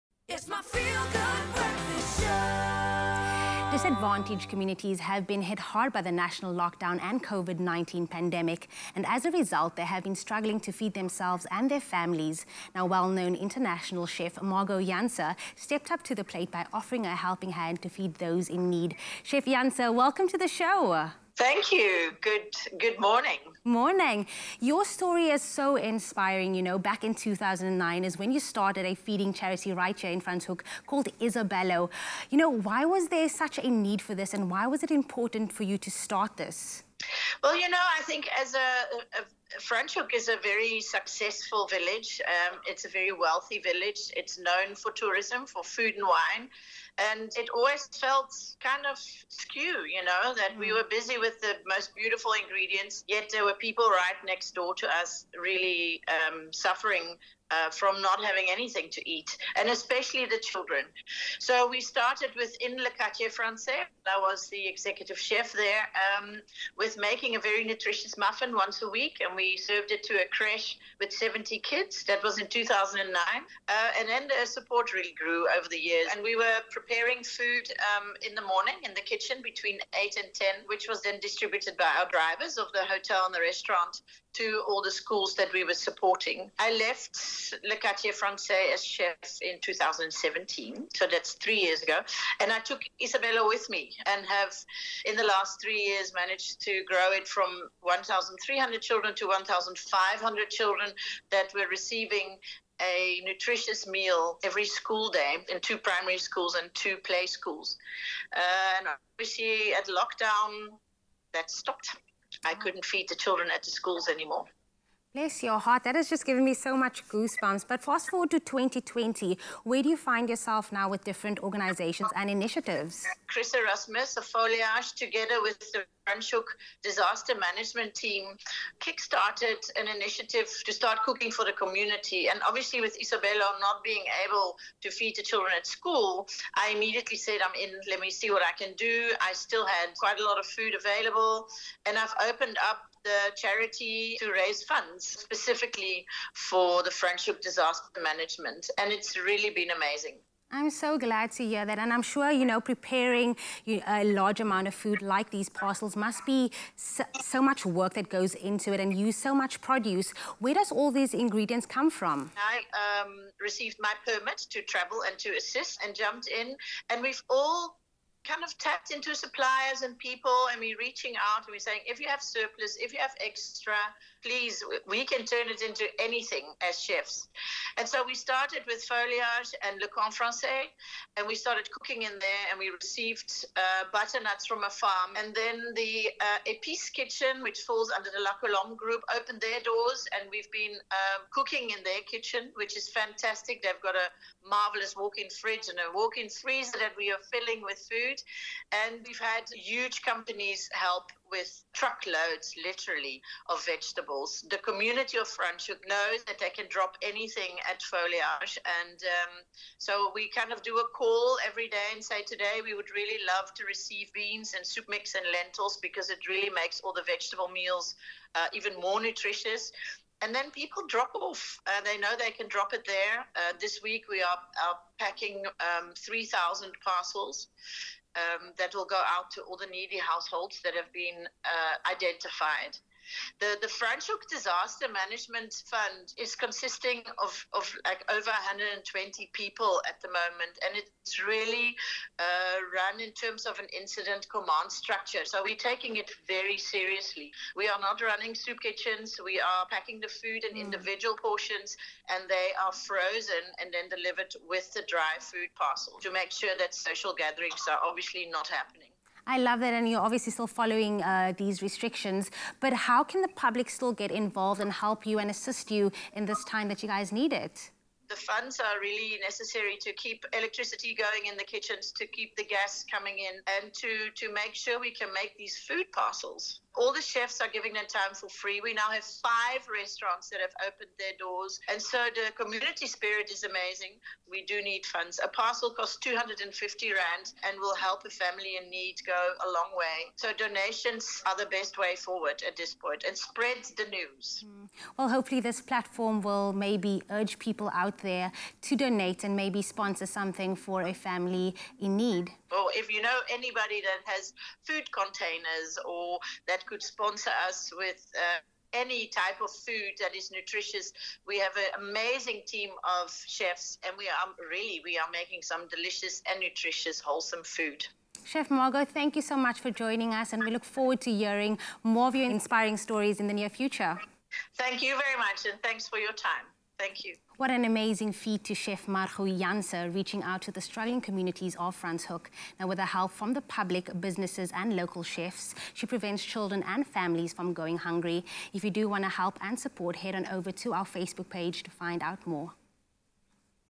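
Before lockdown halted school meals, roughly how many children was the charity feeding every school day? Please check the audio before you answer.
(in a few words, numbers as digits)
1,500.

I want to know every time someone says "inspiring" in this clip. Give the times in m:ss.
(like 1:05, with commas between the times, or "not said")
0:25, 5:22.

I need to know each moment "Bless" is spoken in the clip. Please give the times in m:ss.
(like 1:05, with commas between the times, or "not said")
1:55.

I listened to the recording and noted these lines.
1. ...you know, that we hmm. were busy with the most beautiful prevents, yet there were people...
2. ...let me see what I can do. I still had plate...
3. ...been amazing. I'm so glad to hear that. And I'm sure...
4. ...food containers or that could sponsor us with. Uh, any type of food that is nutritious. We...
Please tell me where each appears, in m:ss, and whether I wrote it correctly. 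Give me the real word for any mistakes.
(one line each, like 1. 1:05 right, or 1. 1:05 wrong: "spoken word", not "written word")
1. 0:49 wrong: "ingredients", not "prevents"
2. 2:17 wrong: "quite", not "plate"
3. 2:29 right
4. 5:04 right.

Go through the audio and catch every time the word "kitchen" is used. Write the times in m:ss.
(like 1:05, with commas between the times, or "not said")
1:19, 3:06, 3:12, 4:08, 4:31.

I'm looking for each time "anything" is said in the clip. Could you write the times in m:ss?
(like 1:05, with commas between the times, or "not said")
0:58, 2:55, 3:27.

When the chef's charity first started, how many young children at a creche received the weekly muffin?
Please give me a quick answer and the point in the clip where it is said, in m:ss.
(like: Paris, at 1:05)
70, at 1:11.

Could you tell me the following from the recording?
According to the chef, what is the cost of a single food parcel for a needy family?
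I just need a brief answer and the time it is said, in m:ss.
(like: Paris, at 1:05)
250 Rand, at 4:45.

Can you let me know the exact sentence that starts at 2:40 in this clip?
Where does all these ingredients come from?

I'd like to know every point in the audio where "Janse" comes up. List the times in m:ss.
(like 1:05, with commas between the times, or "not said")
0:14, 0:19, 5:29.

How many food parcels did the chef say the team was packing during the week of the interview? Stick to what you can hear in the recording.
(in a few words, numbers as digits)
3,000.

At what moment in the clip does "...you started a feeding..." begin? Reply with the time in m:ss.
0:28.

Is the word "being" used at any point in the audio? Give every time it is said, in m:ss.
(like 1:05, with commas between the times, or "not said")
2:13.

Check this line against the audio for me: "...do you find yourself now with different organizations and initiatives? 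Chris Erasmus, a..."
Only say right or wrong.
right.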